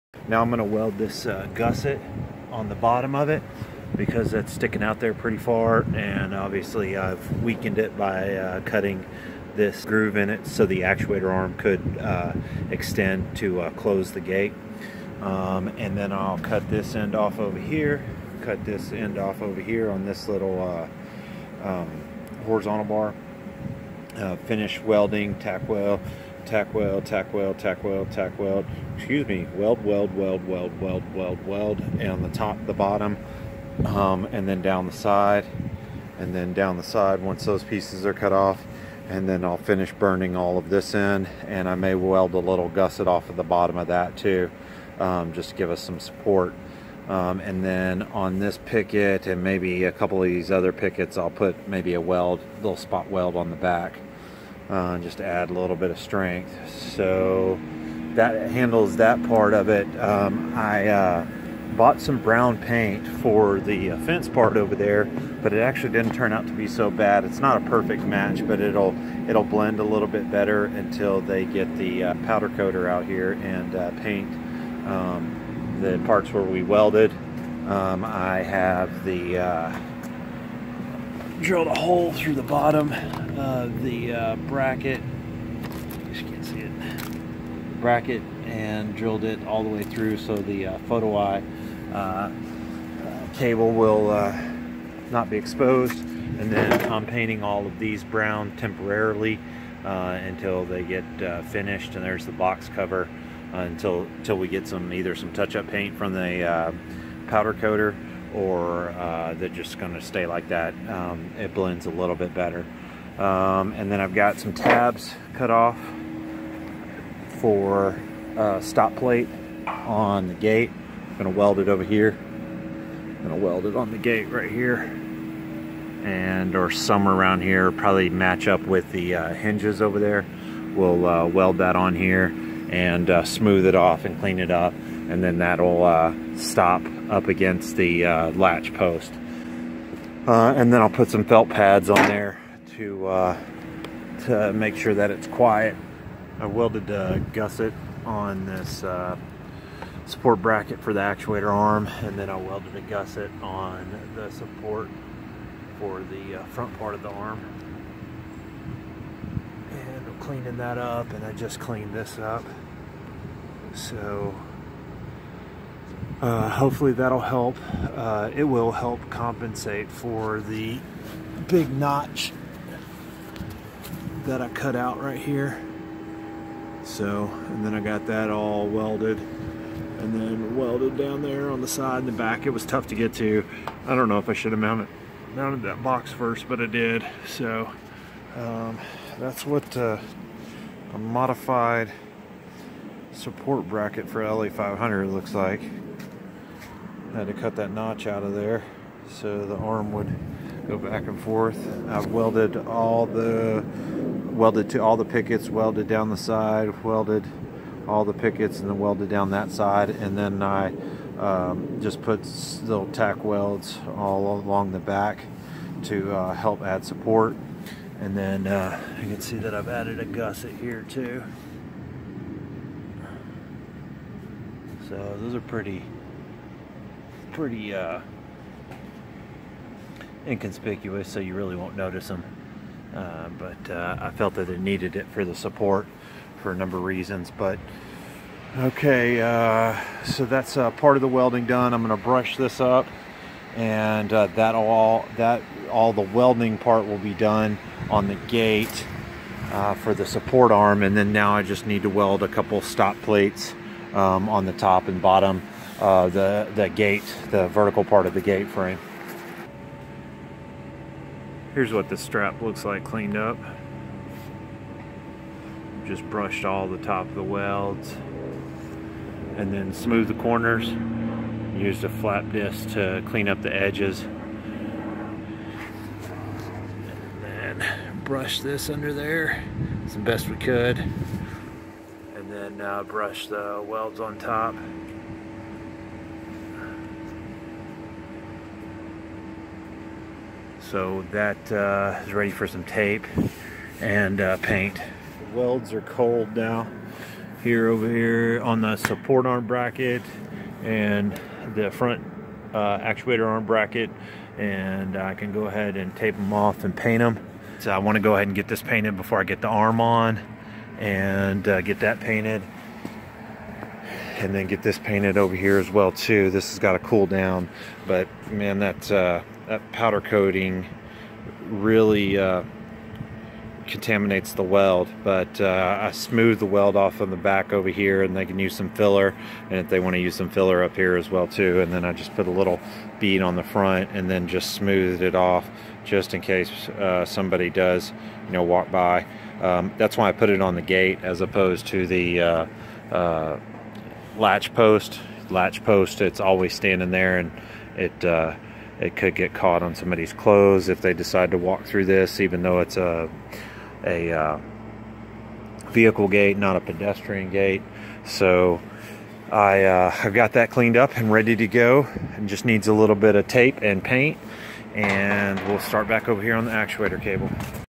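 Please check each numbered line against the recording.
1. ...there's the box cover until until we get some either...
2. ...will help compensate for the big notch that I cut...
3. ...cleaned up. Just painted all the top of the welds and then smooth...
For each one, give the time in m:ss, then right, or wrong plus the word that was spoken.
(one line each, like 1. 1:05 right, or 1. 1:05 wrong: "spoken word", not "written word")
1. 1:42 right
2. 2:48 right
3. 4:22 wrong: "brushed", not "painted".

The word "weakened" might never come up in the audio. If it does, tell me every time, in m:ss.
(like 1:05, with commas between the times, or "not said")
0:07.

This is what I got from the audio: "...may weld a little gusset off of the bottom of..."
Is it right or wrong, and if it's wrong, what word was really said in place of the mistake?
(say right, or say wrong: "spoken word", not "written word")
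right.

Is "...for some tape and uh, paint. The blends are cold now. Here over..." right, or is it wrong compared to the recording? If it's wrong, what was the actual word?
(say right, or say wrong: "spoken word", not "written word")
wrong: "welds", not "blends".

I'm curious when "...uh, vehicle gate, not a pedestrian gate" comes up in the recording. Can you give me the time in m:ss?
5:54.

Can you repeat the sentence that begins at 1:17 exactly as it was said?
Um, I have the uh, drilled a hole through the bottom of the uh, bracket.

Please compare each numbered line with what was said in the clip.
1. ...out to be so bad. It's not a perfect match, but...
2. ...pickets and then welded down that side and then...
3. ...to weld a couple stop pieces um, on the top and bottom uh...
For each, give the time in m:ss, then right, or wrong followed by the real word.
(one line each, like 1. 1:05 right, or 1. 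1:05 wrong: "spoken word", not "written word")
1. 1:06 right
2. 3:28 right
3. 4:11 wrong: "plates", not "pieces".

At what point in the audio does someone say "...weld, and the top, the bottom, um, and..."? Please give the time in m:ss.
0:31.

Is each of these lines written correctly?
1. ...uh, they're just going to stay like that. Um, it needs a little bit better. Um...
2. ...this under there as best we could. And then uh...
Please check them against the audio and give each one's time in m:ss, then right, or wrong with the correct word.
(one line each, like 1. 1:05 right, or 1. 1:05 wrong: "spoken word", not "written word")
1. 1:48 wrong: "blends", not "needs"
2. 4:38 right.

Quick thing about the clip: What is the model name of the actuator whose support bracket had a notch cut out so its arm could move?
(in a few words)
LA500.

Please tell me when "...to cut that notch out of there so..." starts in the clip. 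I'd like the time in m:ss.
3:17.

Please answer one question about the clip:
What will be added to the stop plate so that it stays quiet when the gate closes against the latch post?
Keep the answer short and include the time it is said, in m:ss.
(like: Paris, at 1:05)
Felt pads, at 2:21.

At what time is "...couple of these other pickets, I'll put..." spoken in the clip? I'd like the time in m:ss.
0:49.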